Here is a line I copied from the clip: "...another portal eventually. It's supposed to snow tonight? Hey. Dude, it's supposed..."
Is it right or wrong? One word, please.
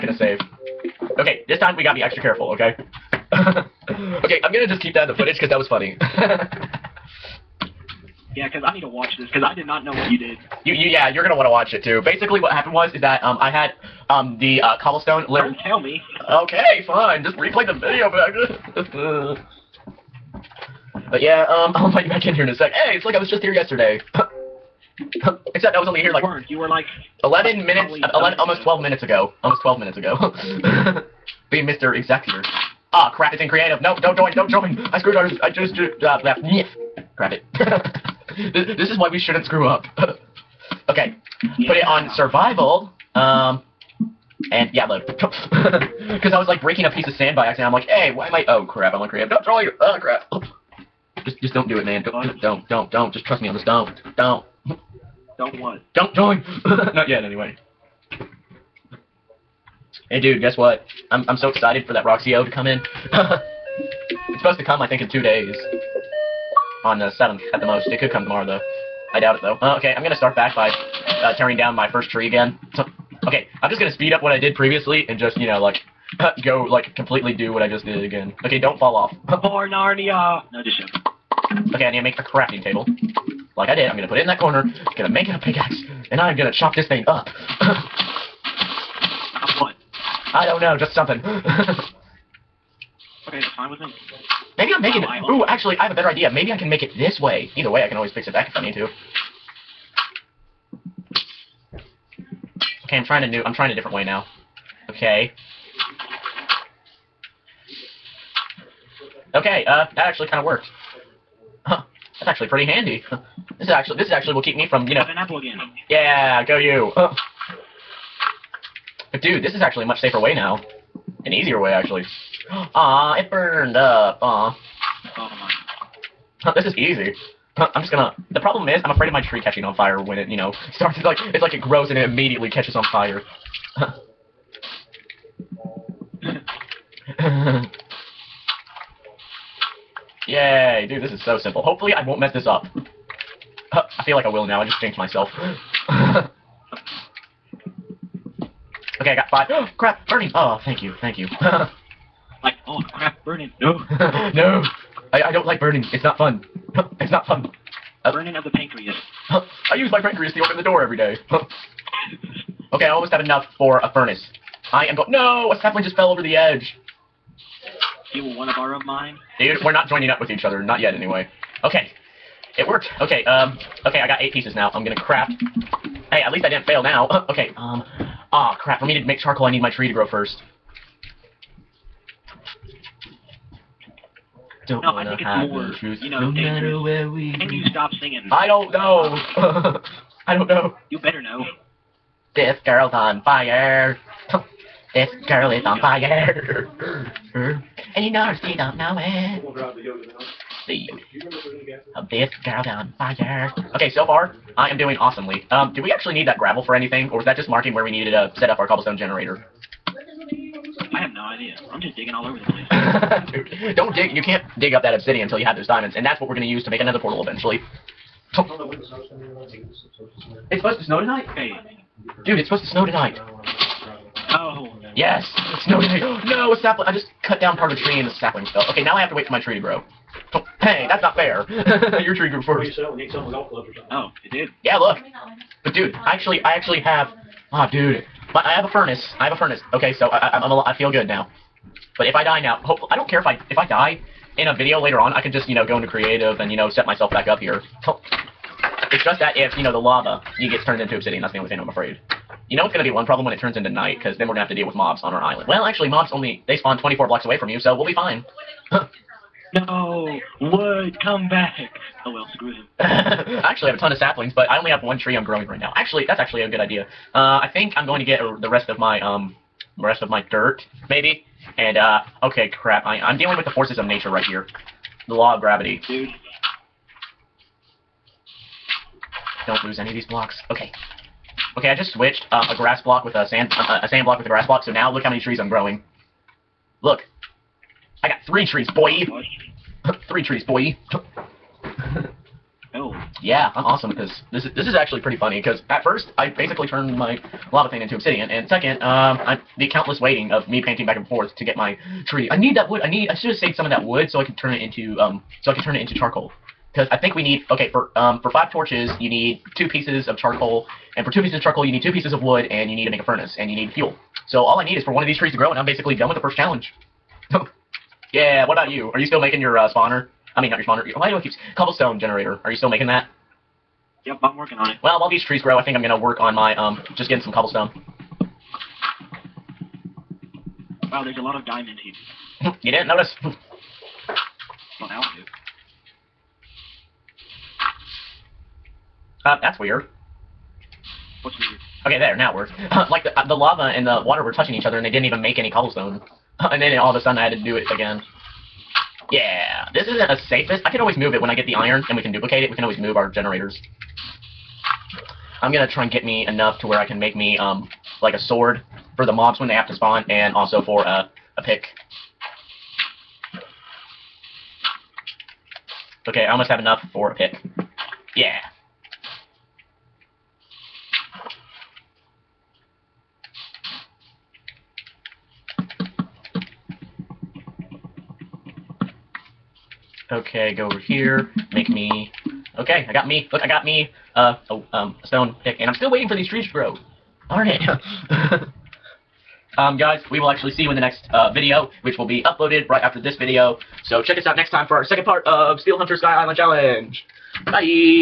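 right.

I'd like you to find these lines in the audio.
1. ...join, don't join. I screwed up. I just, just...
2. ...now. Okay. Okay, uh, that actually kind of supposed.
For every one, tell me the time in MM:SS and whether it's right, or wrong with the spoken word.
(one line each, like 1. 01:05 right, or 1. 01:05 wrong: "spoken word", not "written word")
1. 00:34 right
2. 01:44 wrong: "worked", not "supposed".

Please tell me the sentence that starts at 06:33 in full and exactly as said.
So check us out next time for our second part of Steel Hunter Sky Island Challenge.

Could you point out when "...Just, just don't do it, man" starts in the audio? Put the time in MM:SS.
00:51.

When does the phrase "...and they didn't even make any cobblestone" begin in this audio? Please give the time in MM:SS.
05:44.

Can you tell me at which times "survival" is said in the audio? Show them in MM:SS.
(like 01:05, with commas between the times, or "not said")
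00:42.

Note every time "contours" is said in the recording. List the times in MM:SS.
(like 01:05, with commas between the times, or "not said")
not said.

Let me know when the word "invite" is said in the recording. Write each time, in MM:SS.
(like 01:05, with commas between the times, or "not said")
00:21.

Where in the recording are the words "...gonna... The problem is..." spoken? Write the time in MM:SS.
02:07.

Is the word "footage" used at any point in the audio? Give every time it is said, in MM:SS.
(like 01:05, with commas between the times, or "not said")
00:05.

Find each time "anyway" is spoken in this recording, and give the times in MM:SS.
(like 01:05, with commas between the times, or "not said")
00:57, 02:50.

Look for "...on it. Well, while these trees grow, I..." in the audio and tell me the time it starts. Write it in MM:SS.
05:24.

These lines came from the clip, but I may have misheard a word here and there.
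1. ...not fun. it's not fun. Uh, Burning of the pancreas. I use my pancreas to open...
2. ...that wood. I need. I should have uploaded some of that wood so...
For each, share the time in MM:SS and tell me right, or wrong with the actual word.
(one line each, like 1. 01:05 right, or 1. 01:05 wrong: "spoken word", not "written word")
1. 02:36 right
2. 05:02 wrong: "saved", not "uploaded".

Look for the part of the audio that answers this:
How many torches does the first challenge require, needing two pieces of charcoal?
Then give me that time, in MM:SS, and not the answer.
05:08.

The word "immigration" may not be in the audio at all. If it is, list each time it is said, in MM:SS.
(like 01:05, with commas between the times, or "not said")
not said.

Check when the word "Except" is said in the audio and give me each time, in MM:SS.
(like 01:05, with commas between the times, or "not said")
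00:25.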